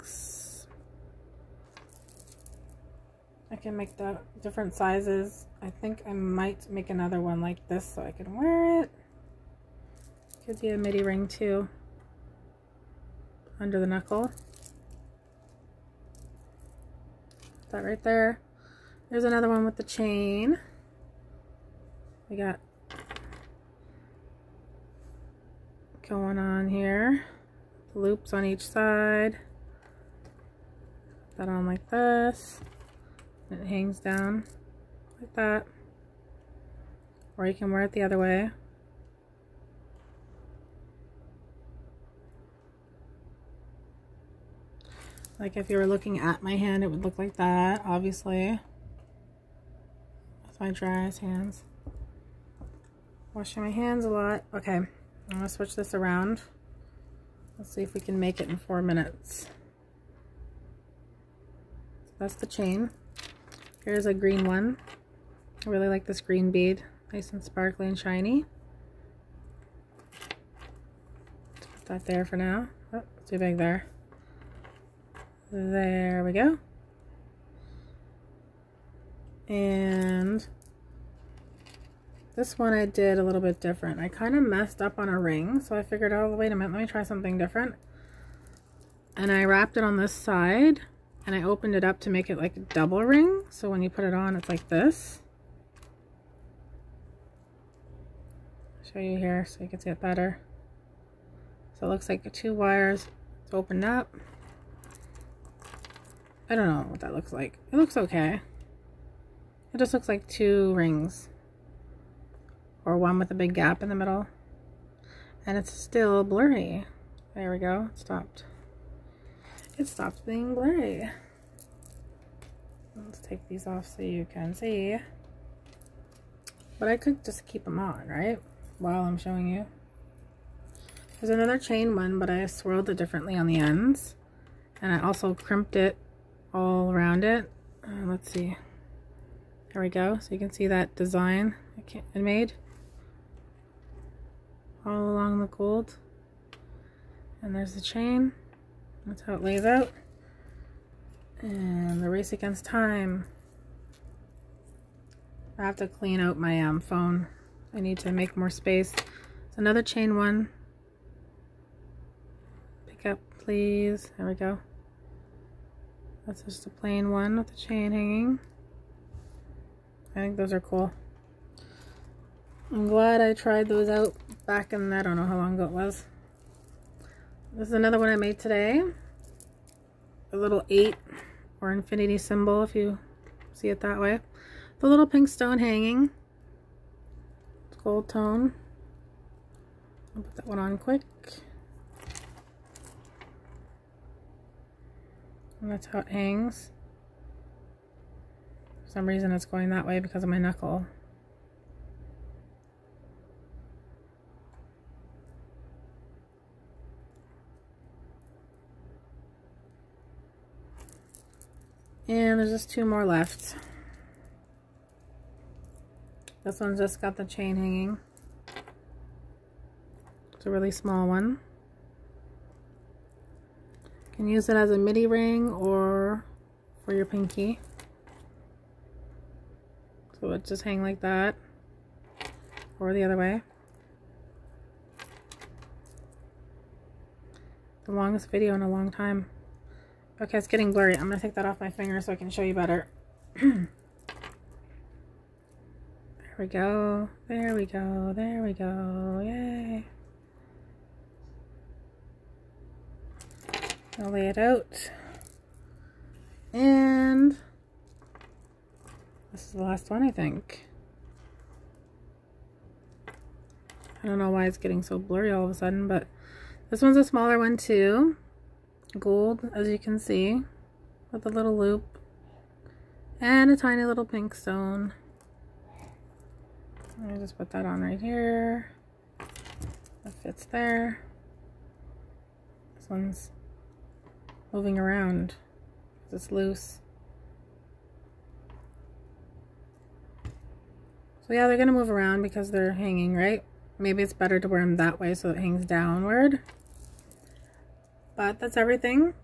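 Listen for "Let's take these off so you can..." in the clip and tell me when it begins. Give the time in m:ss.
2:02.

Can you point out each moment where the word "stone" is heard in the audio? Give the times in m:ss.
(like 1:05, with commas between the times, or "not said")
3:05, 4:34.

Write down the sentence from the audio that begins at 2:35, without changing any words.
I have to clean out my um, phone.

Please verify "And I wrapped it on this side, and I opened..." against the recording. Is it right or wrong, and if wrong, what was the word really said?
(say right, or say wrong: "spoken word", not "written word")
right.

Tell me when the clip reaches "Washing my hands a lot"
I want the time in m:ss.
0:53.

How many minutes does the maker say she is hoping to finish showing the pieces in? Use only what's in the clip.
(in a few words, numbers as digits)
4.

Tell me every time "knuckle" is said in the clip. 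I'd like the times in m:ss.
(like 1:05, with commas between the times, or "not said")
0:13, 3:20.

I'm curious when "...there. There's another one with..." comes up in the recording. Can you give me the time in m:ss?
0:18.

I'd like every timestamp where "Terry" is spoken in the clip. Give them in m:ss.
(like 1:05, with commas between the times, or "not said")
not said.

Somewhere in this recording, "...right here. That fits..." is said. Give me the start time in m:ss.
4:37.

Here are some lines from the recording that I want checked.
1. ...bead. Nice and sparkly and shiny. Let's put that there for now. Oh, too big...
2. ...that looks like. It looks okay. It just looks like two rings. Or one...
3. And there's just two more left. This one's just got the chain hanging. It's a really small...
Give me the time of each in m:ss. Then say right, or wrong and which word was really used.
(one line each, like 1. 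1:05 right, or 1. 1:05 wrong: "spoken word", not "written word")
1. 1:06 right
2. 1:46 right
3. 3:32 right.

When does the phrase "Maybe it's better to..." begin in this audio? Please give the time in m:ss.
4:53.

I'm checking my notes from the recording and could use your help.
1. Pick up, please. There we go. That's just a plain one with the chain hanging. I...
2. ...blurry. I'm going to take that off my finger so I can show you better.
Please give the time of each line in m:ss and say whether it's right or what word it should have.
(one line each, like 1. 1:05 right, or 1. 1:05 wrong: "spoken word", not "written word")
1. 2:42 right
2. 4:00 right.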